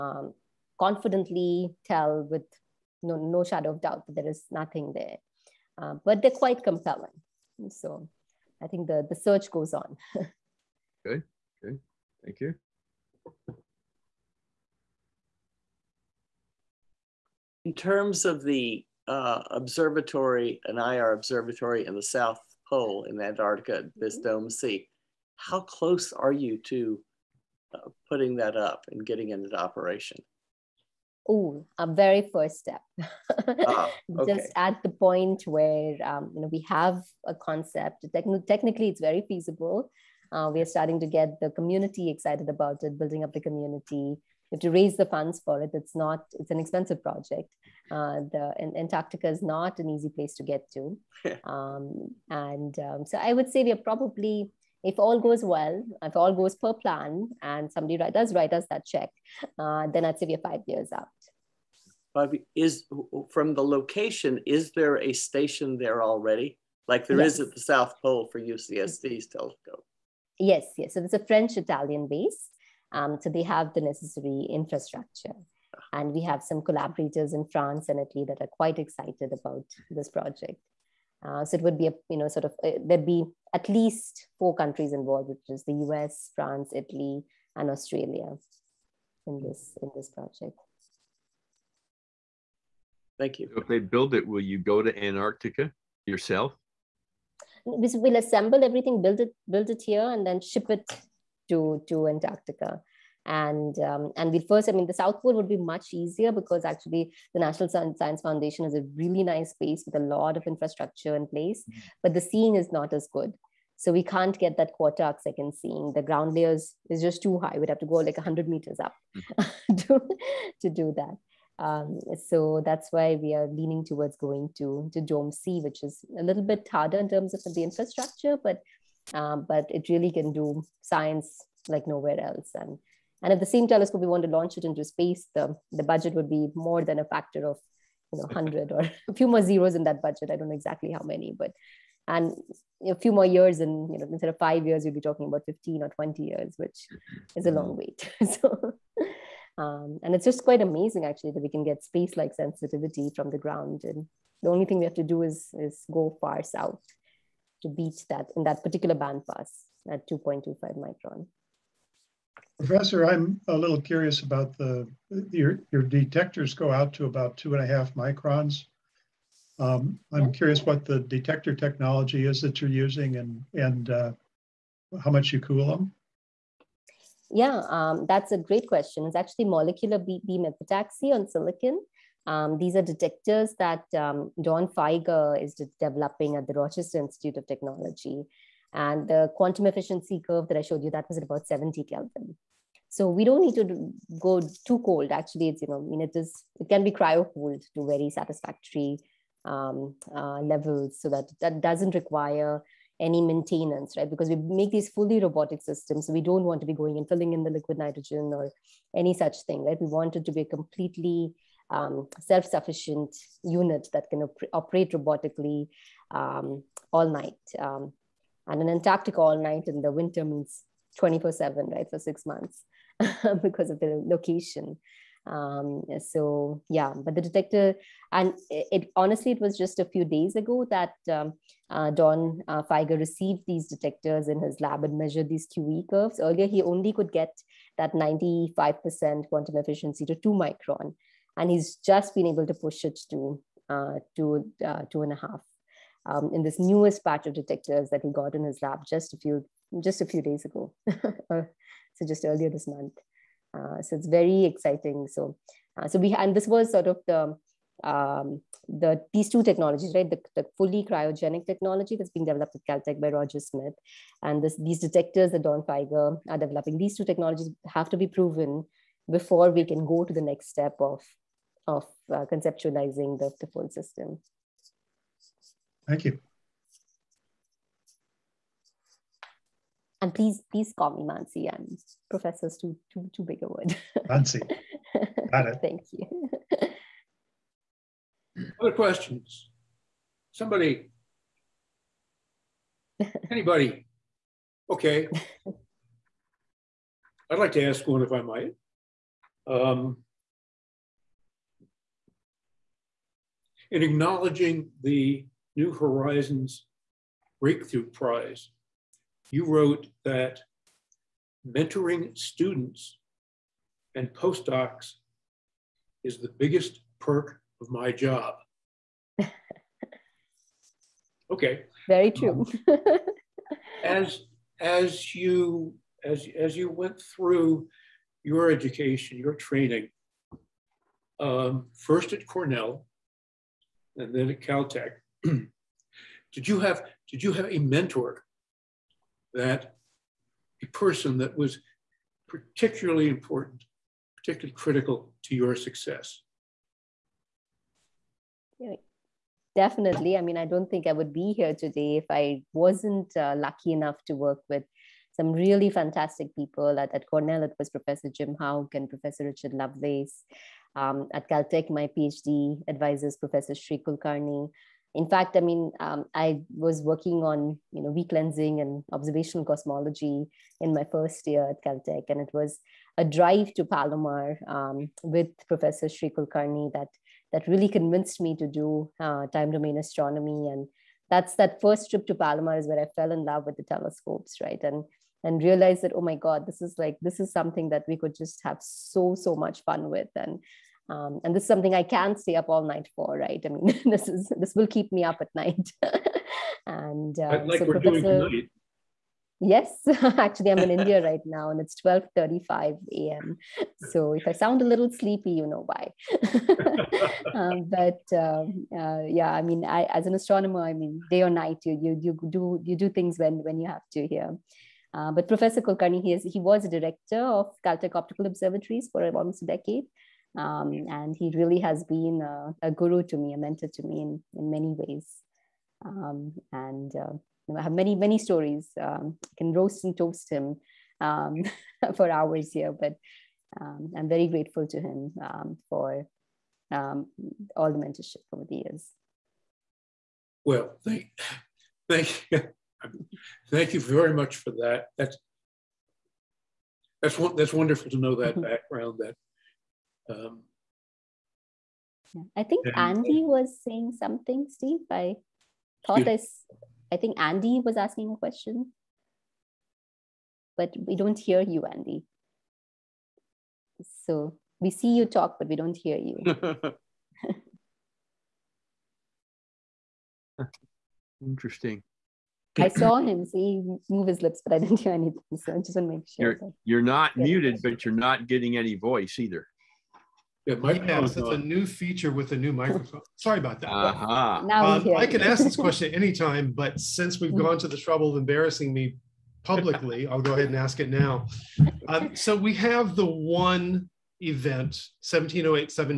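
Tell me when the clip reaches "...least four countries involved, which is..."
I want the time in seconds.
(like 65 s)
83 s.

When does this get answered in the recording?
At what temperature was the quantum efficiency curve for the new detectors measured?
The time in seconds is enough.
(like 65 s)
191 s.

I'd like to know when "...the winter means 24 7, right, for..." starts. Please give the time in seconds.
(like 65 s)
219 s.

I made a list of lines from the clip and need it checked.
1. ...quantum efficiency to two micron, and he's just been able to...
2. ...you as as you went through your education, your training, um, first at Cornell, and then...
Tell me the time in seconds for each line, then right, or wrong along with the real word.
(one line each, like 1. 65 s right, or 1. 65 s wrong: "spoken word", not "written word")
1. 239 s right
2. 325 s right.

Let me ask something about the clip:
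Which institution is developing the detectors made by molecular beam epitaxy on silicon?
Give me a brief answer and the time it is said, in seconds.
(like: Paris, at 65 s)
Rochester Institute of Technology, at 186 s.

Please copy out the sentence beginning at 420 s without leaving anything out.
Um, and he really has been a, a, guru to me, a mentor to me in, in many ways.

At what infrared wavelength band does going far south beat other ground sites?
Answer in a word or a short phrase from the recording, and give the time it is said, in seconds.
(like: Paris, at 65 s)
2.25 micron, at 160 s.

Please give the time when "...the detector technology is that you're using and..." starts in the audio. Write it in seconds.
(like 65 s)
170 s.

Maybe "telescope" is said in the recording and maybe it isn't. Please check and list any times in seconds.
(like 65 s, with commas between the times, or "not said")
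69 s, 133 s, 383 s.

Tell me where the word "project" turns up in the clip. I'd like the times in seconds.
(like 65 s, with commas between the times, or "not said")
47 s, 80 s, 90 s.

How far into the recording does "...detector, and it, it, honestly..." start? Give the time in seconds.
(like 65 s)
227 s.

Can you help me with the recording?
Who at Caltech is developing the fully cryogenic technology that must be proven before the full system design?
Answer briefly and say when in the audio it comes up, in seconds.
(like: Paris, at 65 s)
Roger Smith, at 263 s.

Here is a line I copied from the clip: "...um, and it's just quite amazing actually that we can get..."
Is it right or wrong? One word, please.
right.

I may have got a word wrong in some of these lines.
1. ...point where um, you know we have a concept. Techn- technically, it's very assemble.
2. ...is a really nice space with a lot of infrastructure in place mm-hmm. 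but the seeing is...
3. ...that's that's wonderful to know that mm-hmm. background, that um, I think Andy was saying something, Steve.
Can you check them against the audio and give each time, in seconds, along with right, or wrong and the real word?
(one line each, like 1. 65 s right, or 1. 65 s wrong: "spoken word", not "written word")
1. 34 s wrong: "feasible", not "assemble"
2. 108 s right
3. 447 s right.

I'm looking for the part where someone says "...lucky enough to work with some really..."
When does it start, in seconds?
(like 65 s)
353 s.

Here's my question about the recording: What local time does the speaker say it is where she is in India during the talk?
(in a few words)
12:35 a.m.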